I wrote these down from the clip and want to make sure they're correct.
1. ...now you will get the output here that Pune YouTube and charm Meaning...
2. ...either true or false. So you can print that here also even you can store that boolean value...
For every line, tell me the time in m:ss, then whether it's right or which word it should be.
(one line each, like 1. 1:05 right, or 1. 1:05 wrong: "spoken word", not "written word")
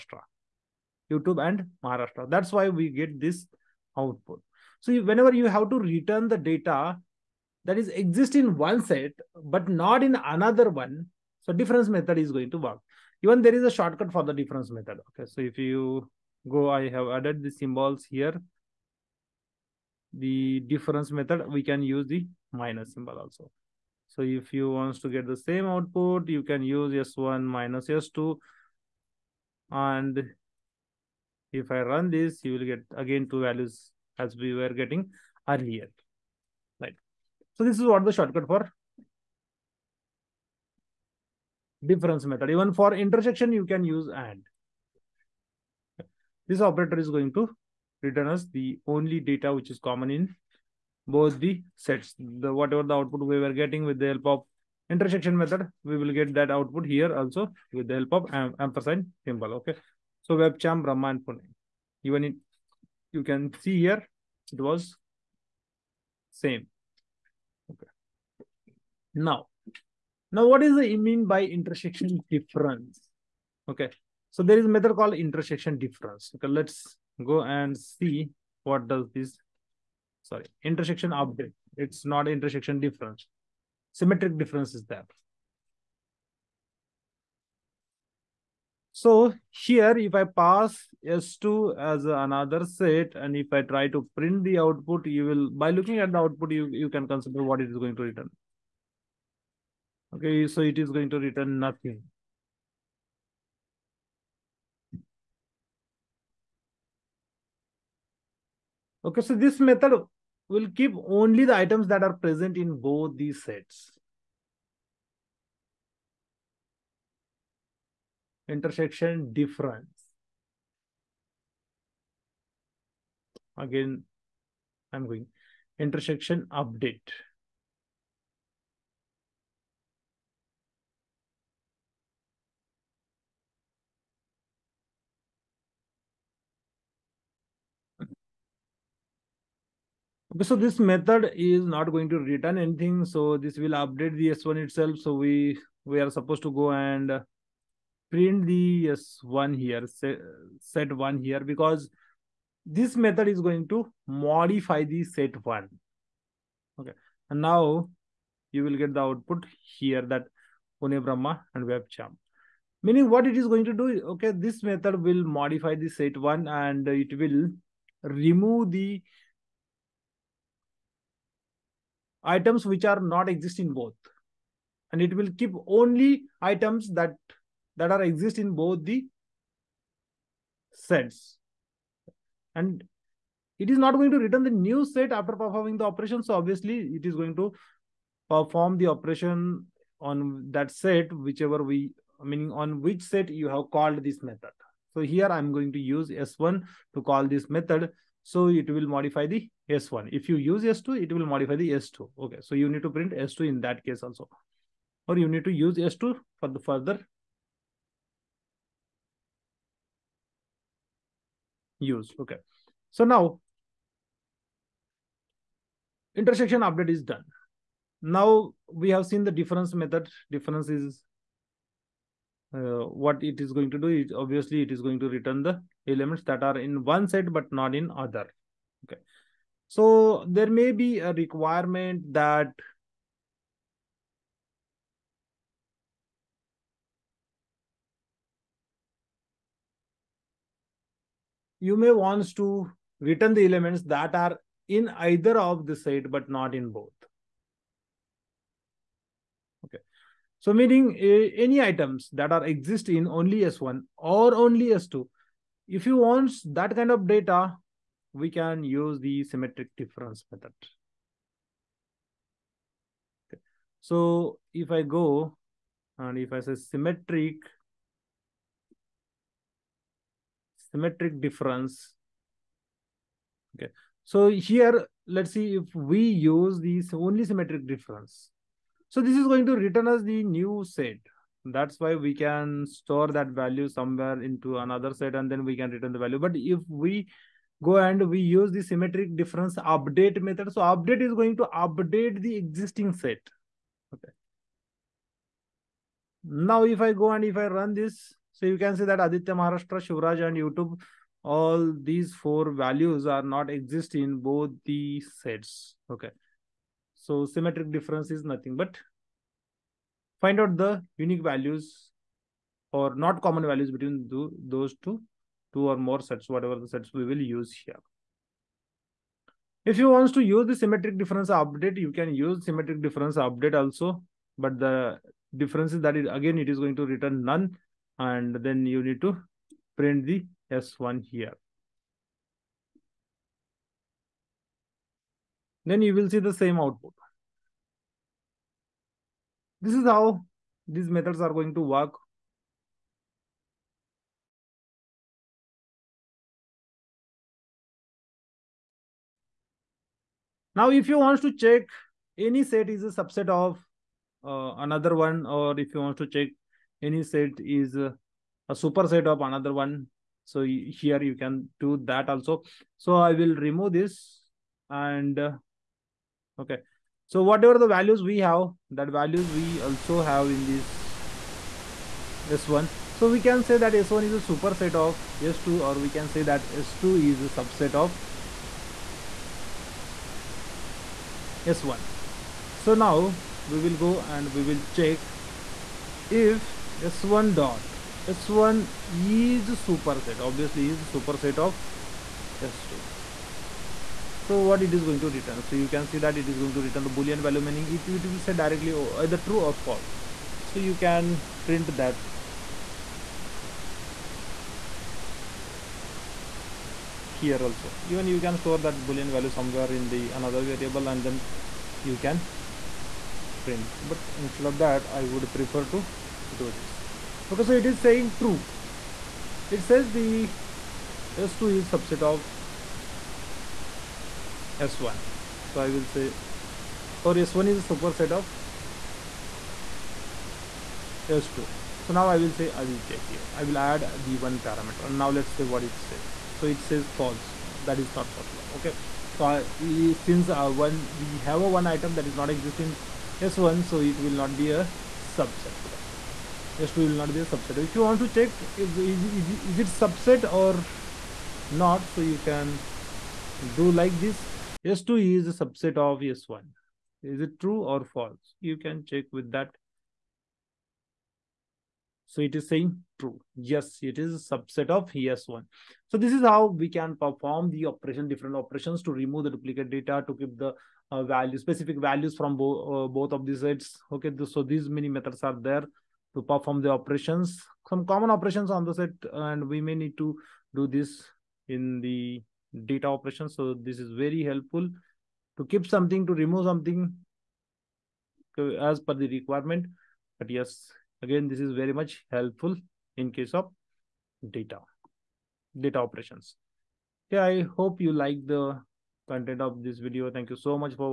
1. 2:37 wrong: "Brahma", not "YouTube"
2. 6:39 right.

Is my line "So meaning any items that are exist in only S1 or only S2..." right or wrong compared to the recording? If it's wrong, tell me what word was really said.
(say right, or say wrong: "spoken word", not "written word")
right.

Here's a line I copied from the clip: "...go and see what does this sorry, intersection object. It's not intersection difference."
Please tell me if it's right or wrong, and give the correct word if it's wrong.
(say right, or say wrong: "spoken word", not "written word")
right.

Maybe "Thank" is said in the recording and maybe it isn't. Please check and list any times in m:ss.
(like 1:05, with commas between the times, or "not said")
8:20.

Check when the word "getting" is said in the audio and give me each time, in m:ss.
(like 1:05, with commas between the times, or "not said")
0:34, 0:53.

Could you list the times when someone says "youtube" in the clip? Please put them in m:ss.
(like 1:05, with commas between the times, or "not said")
0:01, 5:00.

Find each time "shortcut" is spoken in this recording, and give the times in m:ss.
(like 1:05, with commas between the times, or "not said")
0:13, 0:38.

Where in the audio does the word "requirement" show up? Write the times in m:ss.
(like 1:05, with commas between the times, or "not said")
3:51, 8:09.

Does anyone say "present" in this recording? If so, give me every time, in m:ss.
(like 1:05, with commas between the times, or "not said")
1:52.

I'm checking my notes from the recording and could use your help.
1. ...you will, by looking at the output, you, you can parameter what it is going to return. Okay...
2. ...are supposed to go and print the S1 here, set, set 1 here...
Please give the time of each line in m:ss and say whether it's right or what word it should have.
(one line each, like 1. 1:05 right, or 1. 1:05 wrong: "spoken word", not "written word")
1. 1:35 wrong: "consider", not "parameter"
2. 2:26 right.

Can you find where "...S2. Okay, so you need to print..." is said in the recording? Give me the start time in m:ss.
3:21.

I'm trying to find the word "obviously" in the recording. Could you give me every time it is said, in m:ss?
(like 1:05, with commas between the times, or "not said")
3:06, 3:44, 6:30.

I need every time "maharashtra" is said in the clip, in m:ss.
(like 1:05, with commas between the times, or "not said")
0:01, 4:59.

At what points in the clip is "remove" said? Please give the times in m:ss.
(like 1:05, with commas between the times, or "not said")
2:48, 6:03, 7:48, 8:06.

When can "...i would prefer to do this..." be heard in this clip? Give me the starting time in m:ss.
6:54.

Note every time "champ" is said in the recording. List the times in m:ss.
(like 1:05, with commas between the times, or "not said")
1:00.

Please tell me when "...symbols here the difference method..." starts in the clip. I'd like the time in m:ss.
0:17.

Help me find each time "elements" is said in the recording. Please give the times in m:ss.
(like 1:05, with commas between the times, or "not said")
3:45, 4:03.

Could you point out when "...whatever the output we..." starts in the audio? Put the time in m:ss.
0:52.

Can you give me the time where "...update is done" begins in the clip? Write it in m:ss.
3:36.